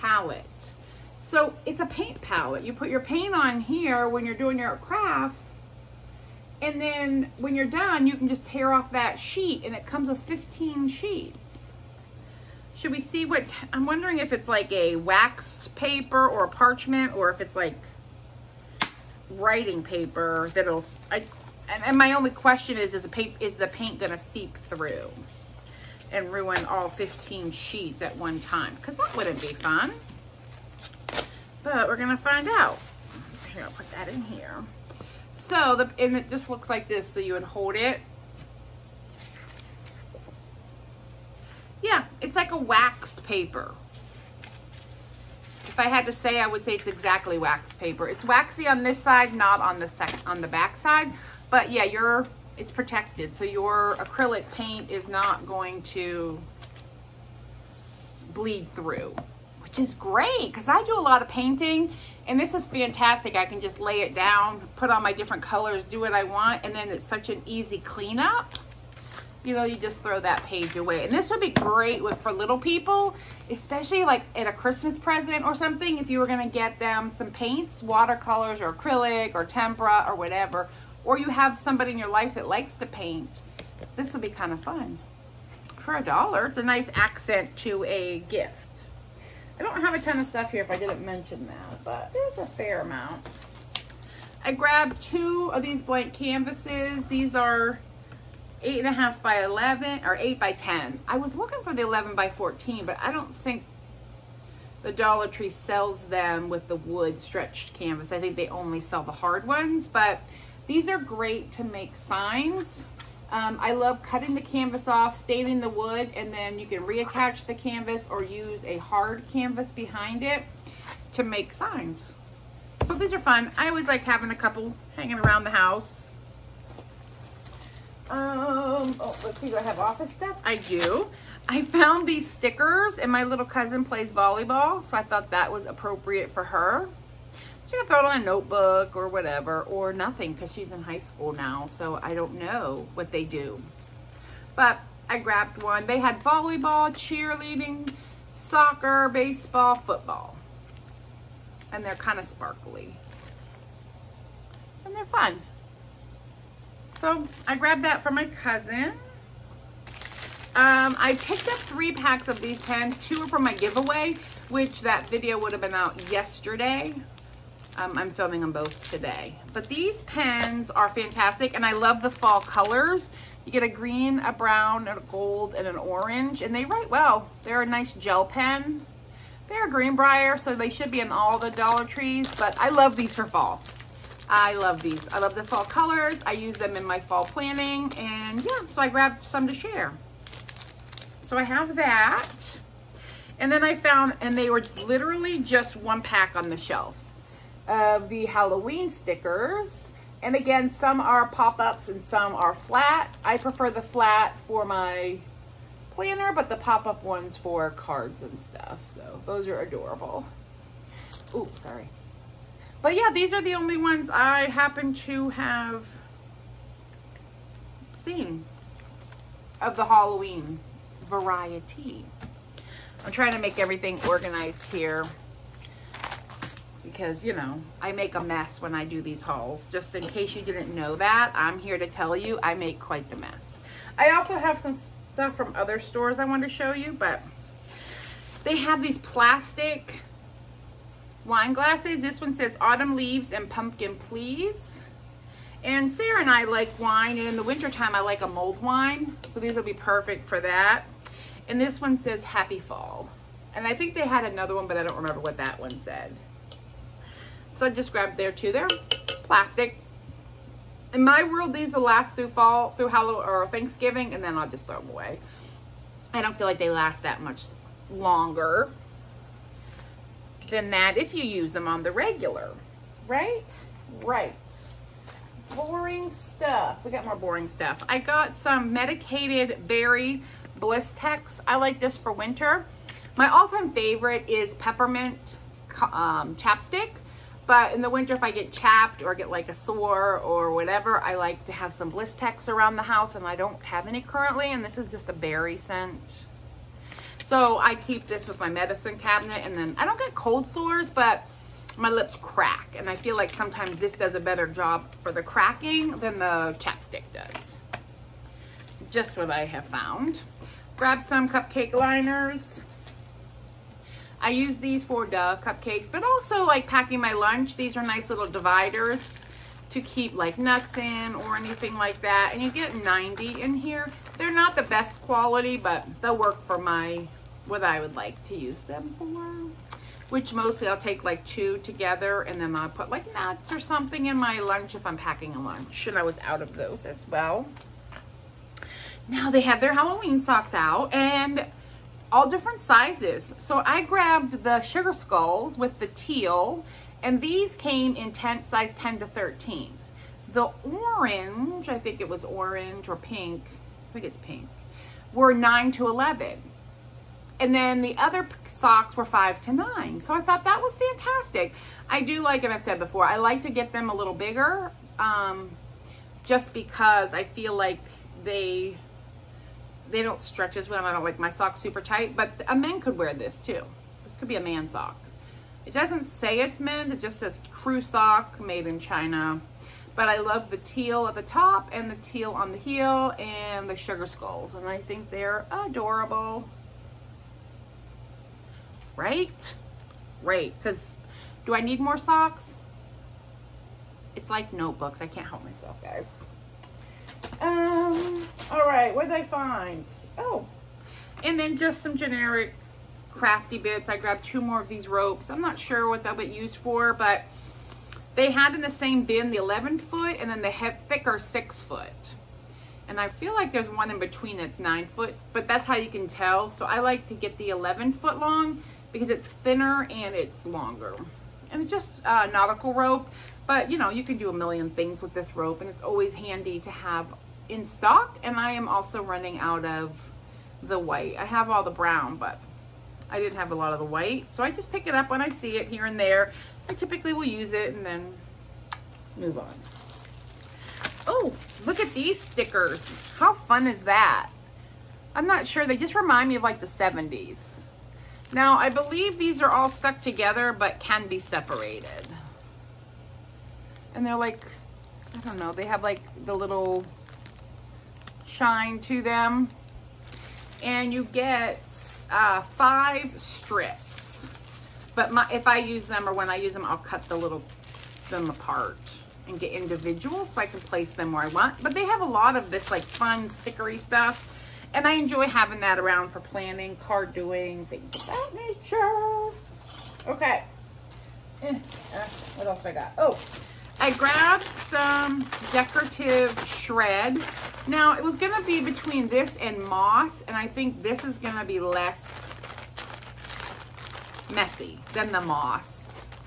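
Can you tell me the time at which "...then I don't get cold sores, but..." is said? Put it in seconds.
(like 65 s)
299 s.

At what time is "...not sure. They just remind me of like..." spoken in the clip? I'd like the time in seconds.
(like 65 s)
445 s.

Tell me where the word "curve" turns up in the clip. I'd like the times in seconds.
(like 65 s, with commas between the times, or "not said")
not said.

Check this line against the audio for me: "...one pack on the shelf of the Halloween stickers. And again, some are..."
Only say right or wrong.
right.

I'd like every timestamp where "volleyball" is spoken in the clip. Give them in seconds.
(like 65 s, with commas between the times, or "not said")
134 s, 146 s.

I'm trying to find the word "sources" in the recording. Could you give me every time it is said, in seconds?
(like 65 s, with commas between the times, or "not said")
not said.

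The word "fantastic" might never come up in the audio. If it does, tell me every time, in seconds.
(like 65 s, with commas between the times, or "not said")
62 s, 170 s, 360 s.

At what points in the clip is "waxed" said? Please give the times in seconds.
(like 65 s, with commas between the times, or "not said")
42 s, 47 s.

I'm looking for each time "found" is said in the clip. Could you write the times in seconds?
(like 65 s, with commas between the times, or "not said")
131 s, 193 s, 309 s.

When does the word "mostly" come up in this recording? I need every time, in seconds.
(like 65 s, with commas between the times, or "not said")
330 s.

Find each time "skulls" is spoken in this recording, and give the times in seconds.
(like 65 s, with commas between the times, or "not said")
344 s, 384 s.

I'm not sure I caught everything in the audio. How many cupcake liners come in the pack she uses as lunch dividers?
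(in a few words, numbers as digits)
90.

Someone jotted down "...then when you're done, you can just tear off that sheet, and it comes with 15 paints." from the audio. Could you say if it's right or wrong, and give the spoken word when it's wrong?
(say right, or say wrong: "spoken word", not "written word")
wrong: "sheets", not "paints".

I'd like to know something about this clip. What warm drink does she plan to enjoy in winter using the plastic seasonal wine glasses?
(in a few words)
mulled wine.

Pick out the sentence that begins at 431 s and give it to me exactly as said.
I have all the brown, but I didn't have a lot of the white.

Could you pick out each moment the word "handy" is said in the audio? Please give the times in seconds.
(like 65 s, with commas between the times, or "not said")
426 s.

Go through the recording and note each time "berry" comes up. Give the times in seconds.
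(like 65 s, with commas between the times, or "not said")
279 s, 295 s.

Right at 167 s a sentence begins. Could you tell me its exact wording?
Um, I'm filming them both today.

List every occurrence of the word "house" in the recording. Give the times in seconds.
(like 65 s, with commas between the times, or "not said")
125 s, 292 s.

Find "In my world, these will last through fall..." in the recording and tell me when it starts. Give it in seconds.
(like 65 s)
260 s.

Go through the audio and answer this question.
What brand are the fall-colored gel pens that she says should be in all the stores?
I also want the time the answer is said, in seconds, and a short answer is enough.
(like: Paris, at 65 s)
Greenbrier, at 179 s.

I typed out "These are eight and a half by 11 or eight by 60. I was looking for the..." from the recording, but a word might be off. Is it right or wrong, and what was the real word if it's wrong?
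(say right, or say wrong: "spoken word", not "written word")
wrong: "10", not "60".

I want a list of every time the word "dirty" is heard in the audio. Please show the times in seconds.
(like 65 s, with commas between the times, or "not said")
not said.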